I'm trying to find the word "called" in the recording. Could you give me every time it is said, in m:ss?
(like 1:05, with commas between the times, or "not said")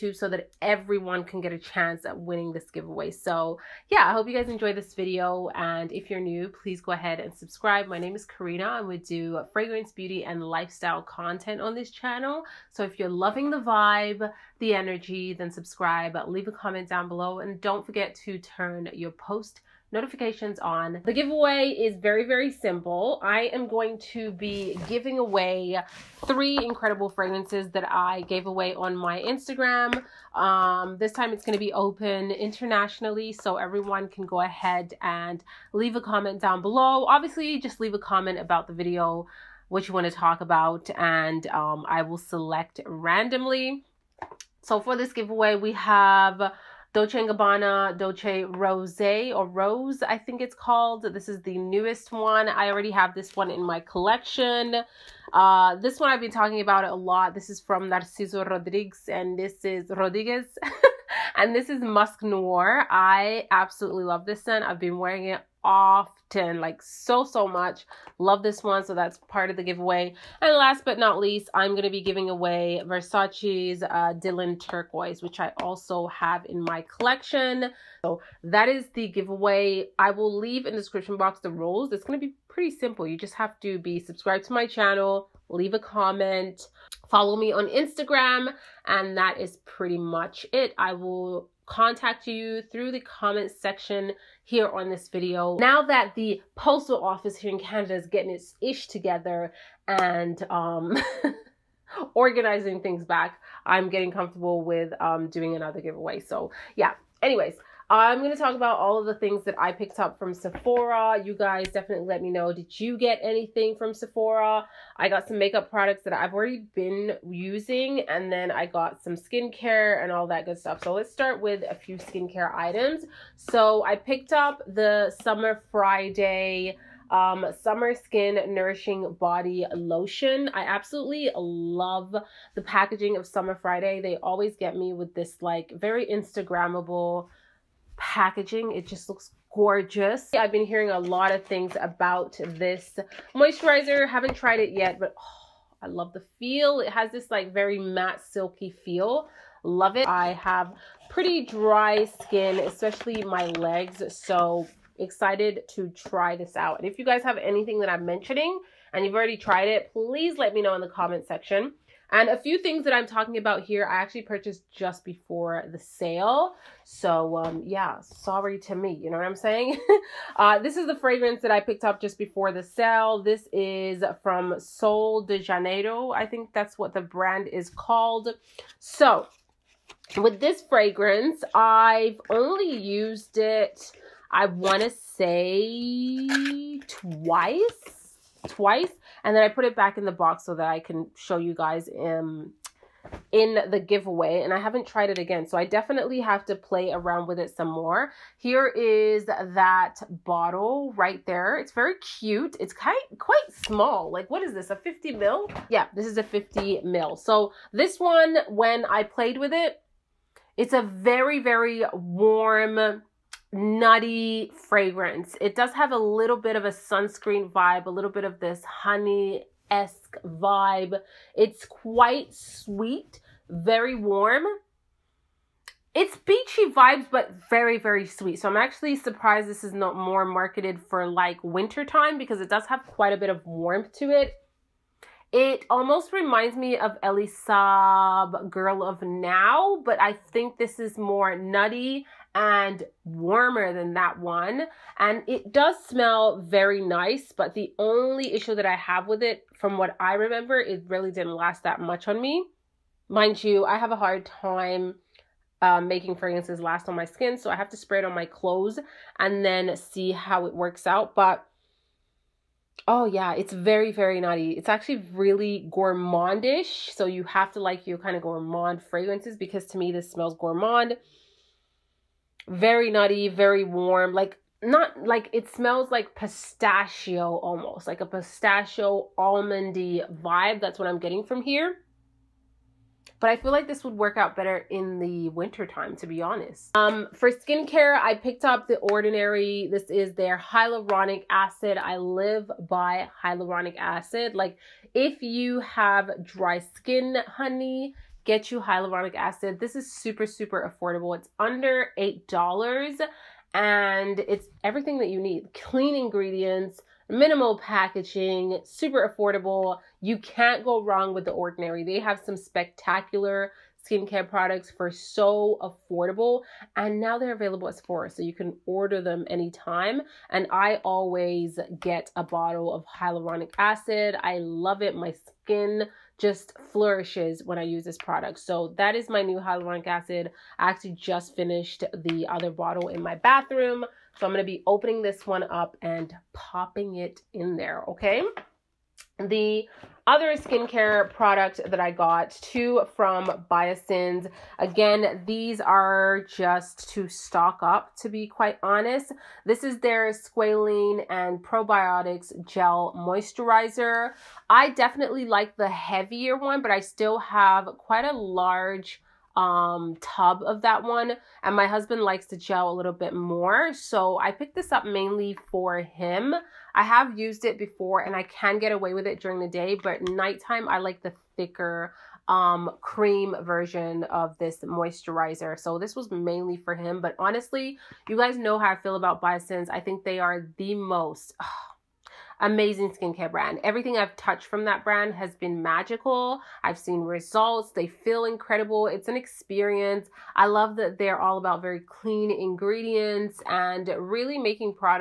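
0:50, 2:57.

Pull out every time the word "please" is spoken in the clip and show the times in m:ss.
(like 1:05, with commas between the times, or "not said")
0:06, 2:39.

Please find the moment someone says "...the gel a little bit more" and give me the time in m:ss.
6:02.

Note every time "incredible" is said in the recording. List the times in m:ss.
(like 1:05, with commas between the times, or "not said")
0:26, 6:28.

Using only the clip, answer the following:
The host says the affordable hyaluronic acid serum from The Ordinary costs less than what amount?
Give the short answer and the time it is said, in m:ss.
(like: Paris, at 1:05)
$8, at 5:01.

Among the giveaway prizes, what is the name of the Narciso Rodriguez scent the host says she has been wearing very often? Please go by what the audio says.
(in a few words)
Musk Noir.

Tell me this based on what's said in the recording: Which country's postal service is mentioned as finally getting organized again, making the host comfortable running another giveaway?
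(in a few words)
Canada.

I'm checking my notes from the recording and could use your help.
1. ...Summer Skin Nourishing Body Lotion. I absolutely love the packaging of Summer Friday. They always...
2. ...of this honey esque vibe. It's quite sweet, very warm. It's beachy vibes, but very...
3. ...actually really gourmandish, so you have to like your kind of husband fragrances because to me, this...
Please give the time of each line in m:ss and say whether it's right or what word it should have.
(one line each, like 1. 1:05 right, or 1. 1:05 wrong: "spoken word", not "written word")
1. 2:07 right
2. 3:38 right
3. 4:24 wrong: "gourmand", not "husband".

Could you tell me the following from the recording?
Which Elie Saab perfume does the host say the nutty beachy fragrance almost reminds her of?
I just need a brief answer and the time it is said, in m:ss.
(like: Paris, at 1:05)
Girl of Now, at 3:58.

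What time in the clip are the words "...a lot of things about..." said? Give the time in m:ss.
2:20.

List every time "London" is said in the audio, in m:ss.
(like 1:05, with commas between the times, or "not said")
not said.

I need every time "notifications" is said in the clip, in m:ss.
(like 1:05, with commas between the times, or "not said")
0:19.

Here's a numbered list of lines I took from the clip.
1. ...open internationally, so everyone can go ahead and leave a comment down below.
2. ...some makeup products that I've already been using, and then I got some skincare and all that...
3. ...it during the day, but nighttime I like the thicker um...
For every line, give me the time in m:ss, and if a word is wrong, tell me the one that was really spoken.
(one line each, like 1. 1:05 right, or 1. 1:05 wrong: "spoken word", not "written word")
1. 0:31 right
2. 1:55 right
3. 6:09 right.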